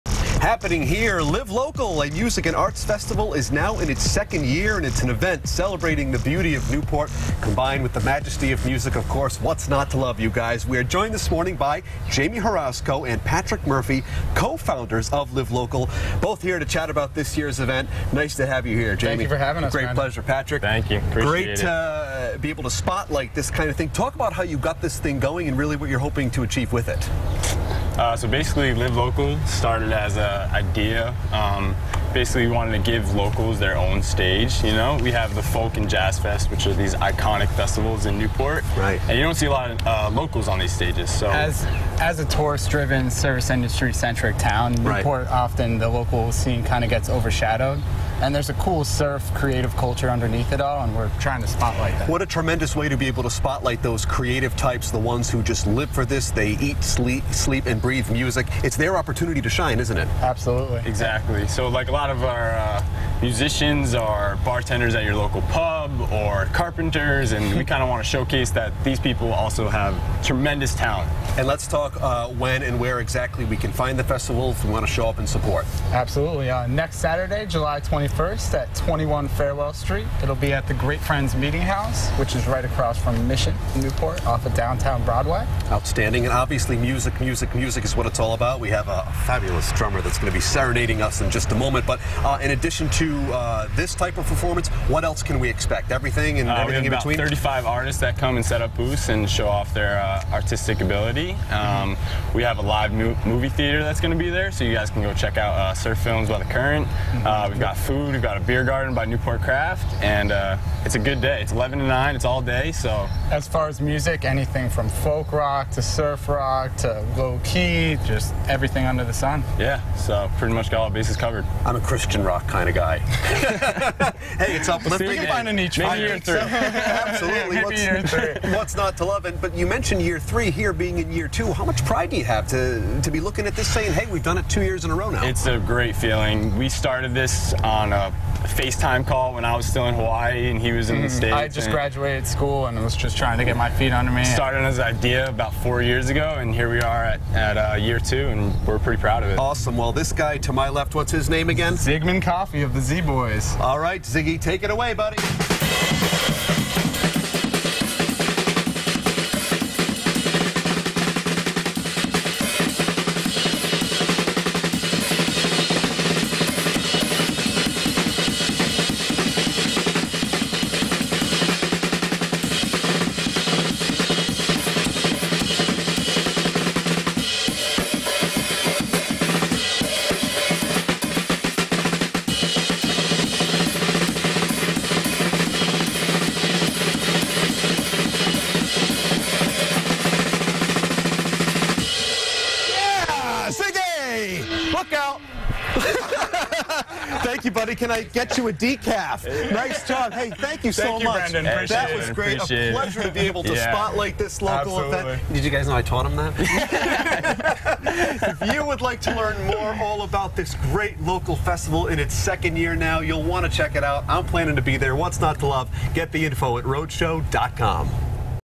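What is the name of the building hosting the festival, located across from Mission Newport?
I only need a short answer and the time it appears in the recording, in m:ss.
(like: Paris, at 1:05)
Great Friends Meeting House, at 1:20.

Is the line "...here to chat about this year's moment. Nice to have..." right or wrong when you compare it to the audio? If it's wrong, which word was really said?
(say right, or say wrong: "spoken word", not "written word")
wrong: "event", not "moment".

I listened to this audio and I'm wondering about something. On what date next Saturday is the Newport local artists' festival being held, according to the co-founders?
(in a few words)
July 21st.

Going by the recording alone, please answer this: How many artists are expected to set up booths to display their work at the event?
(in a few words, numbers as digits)
35.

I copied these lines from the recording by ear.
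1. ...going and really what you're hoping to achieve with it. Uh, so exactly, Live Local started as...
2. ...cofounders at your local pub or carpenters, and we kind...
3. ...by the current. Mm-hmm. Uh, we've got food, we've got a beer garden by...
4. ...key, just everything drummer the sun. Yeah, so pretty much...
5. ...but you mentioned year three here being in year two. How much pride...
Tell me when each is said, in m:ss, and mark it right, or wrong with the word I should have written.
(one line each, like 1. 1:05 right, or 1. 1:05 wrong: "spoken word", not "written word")
1. 0:25 wrong: "basically", not "exactly"
2. 1:04 wrong: "bartenders", not "cofounders"
3. 1:46 right
4. 1:57 wrong: "under", not "drummer"
5. 2:09 right.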